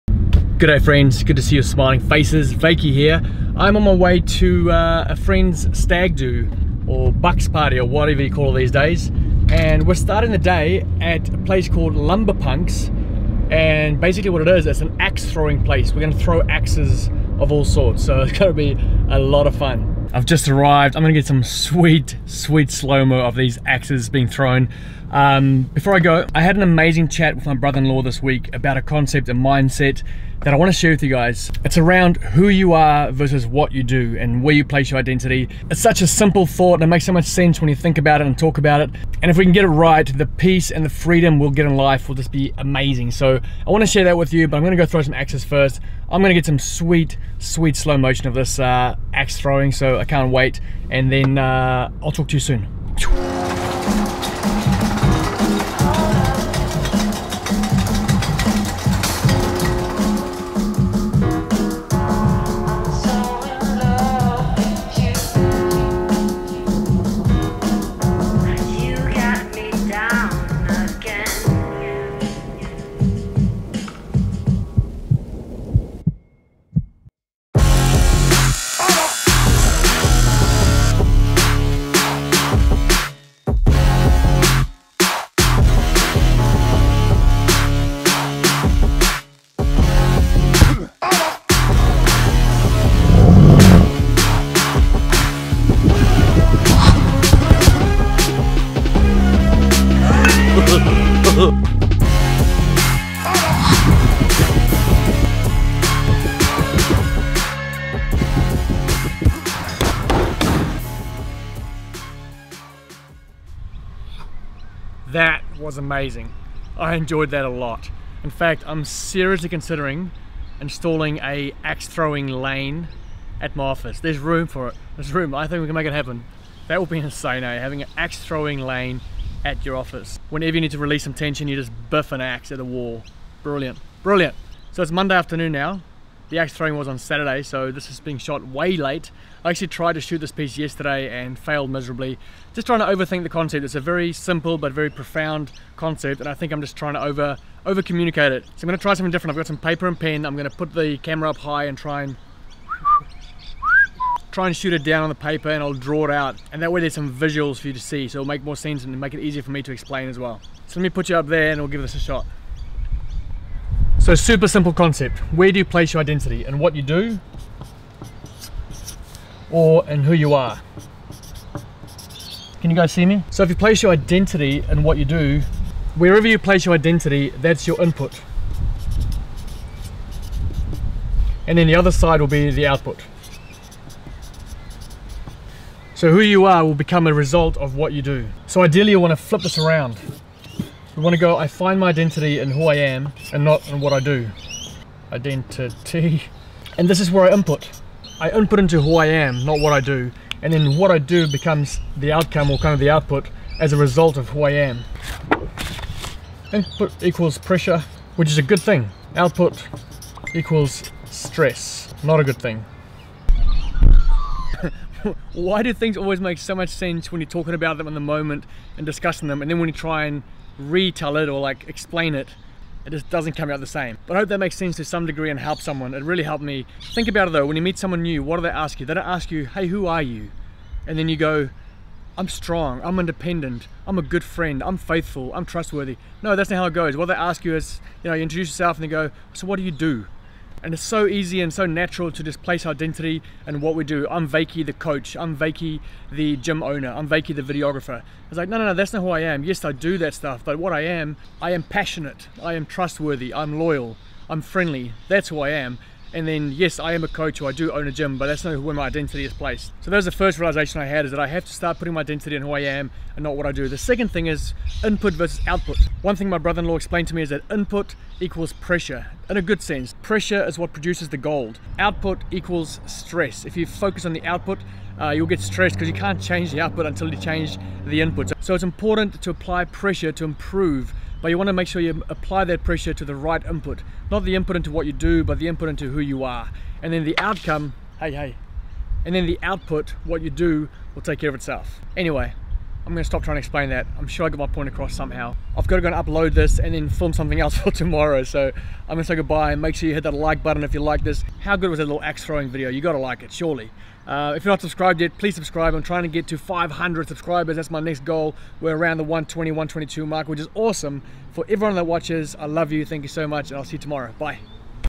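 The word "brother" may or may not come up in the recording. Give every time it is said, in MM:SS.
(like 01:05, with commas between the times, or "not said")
00:27, 04:26.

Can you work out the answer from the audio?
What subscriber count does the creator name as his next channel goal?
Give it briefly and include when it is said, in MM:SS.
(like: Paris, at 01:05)
500, at 05:06.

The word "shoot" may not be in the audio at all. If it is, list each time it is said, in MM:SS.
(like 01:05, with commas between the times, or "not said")
02:20, 02:34.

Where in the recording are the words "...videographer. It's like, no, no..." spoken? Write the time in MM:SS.
04:07.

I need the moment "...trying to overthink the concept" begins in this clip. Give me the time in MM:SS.
02:22.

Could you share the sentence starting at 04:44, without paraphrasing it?
Not the input into what you do, but the input into who you are.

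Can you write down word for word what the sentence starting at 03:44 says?
But I hope that makes sense to some degree and helps someone.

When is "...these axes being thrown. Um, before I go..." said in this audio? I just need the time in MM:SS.
00:23.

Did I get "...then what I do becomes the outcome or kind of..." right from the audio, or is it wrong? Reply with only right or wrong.
right.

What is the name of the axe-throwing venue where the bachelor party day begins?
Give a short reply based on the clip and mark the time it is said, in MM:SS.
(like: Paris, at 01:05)
Lumber Punks, at 00:11.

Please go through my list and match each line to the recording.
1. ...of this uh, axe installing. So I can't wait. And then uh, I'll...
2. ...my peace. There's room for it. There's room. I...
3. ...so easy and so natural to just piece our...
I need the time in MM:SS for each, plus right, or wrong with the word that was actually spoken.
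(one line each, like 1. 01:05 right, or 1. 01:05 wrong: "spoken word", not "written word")
1. 00:48 wrong: "throwing", not "installing"
2. 02:03 wrong: "office", not "peace"
3. 04:00 wrong: "place", not "piece".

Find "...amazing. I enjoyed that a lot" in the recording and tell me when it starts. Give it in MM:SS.
01:55.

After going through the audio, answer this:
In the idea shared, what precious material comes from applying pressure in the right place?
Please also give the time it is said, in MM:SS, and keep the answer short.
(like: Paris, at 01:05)
gold, at 04:31.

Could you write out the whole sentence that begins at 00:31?
It's around who you are versus what you do and where you place your identity.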